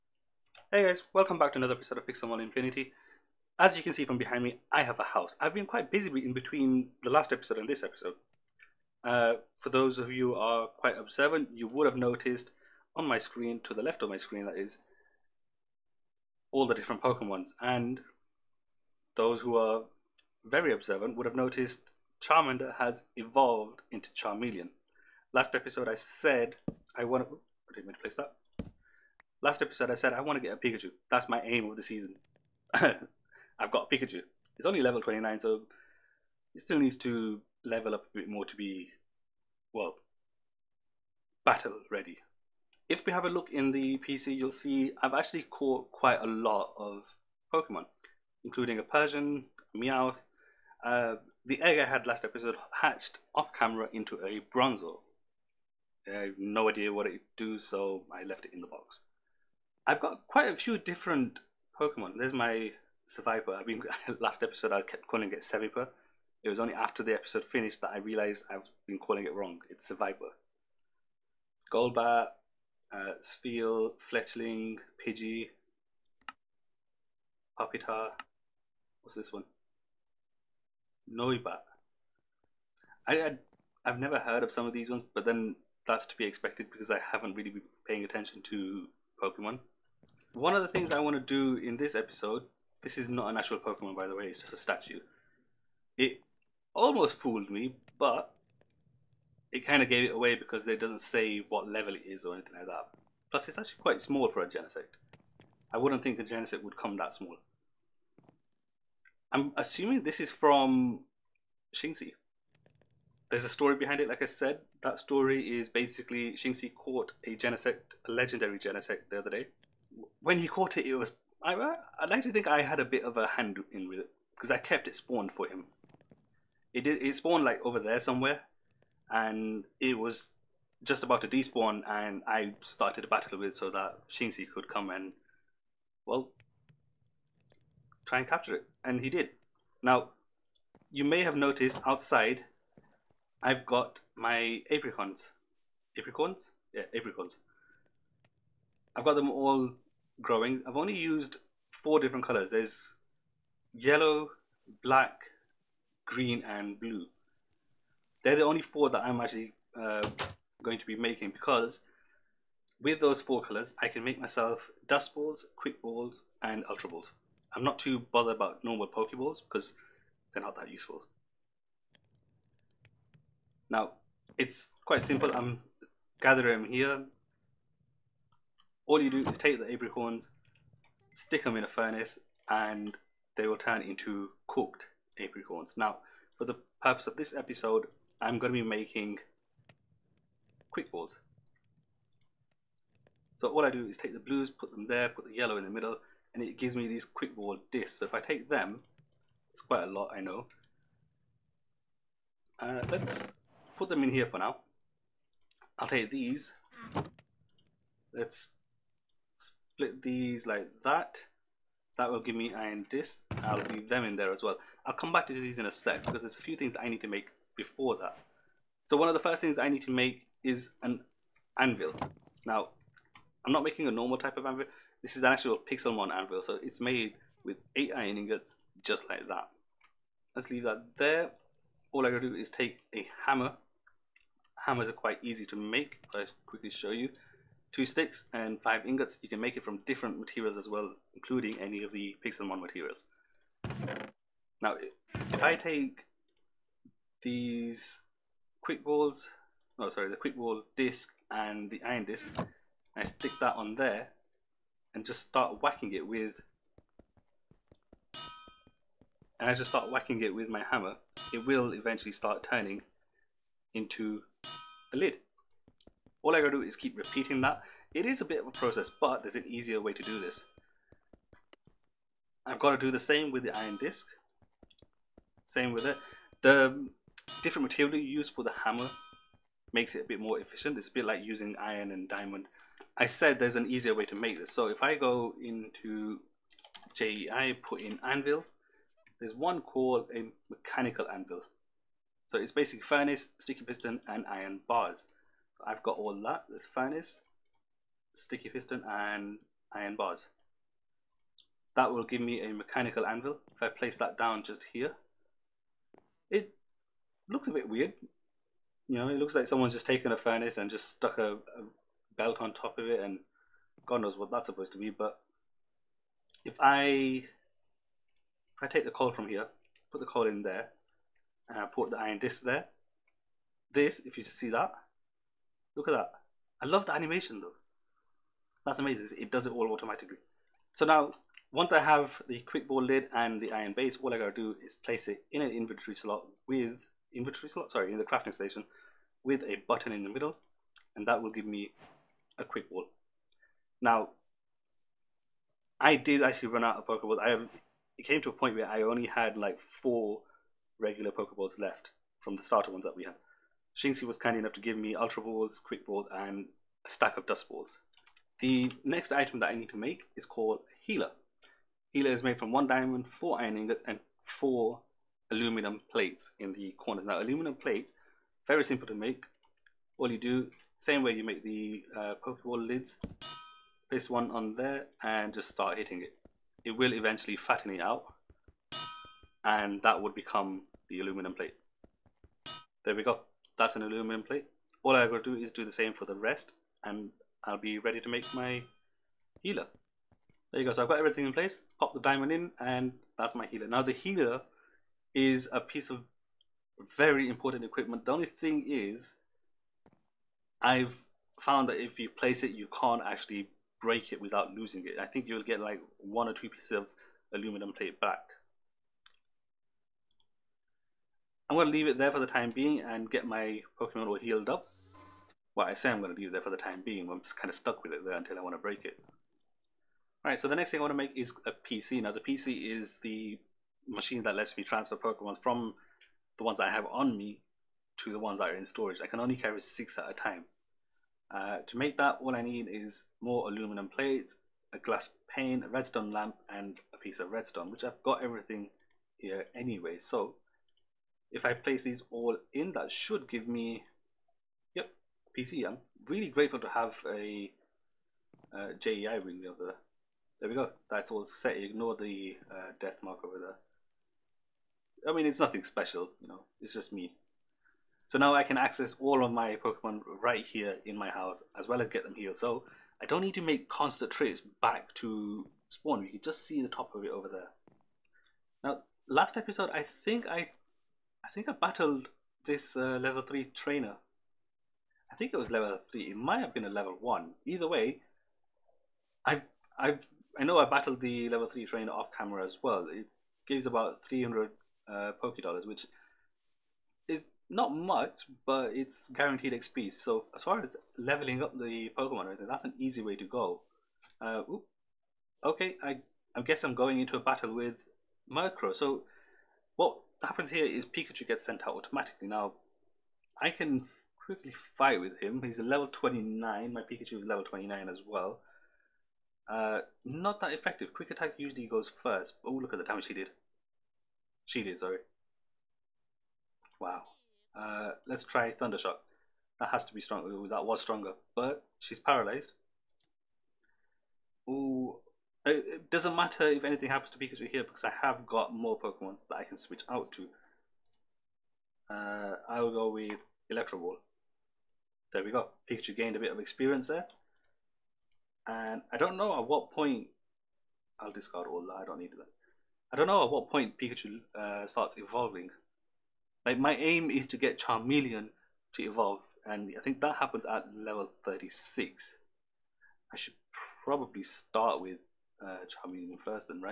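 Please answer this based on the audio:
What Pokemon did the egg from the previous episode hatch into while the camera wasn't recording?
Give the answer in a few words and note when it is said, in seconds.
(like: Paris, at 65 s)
Bronzor, at 54 s.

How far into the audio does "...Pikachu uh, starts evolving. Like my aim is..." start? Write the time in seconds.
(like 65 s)
543 s.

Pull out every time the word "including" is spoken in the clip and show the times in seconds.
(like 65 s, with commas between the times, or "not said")
48 s, 241 s.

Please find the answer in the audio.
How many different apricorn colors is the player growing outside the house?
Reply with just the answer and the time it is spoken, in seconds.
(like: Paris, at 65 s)
4, at 151 s.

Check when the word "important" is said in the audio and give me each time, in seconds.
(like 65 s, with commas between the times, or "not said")
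397 s.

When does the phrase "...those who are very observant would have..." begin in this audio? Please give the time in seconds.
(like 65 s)
19 s.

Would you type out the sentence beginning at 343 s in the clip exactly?
Now, I did actually run out of Pokeballs.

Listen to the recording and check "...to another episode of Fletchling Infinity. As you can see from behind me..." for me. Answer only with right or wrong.
wrong.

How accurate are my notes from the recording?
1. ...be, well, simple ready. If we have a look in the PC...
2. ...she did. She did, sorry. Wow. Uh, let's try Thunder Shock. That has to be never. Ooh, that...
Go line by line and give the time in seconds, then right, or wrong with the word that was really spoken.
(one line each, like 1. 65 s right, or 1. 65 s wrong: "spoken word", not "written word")
1. 38 s wrong: "battle", not "simple"
2. 513 s wrong: "stronger", not "never".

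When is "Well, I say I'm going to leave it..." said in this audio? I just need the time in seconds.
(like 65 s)
415 s.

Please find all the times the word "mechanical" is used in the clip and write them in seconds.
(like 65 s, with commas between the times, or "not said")
290 s, 302 s.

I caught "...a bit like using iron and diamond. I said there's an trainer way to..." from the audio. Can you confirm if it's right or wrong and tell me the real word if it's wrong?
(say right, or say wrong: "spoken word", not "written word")
wrong: "easier", not "trainer".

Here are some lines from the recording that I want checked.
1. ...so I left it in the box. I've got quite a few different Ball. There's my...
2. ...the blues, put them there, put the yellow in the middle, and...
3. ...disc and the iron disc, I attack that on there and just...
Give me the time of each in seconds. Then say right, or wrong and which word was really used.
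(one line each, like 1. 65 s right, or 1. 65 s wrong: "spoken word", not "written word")
1. 57 s wrong: "Pokemon", not "Ball"
2. 194 s right
3. 250 s wrong: "stick", not "attack".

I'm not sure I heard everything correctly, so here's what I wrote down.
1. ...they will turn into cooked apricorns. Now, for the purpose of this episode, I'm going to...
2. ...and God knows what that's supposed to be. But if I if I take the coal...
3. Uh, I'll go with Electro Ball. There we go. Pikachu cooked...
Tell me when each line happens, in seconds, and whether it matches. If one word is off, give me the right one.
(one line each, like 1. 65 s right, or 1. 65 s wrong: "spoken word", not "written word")
1. 183 s right
2. 312 s right
3. 531 s wrong: "gained", not "cooked".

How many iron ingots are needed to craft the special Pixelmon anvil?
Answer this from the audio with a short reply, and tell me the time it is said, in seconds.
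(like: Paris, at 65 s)
8, at 227 s.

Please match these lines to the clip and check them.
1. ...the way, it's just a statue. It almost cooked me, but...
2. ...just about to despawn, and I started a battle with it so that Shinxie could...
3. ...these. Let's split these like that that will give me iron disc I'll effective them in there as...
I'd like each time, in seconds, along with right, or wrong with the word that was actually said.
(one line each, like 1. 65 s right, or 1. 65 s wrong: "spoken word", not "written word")
1. 94 s wrong: "fooled", not "cooked"
2. 130 s right
3. 206 s wrong: "leave", not "effective".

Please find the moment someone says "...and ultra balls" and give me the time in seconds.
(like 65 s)
166 s.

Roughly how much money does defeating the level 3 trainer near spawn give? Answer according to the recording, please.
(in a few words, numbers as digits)
300 Poké Dollars.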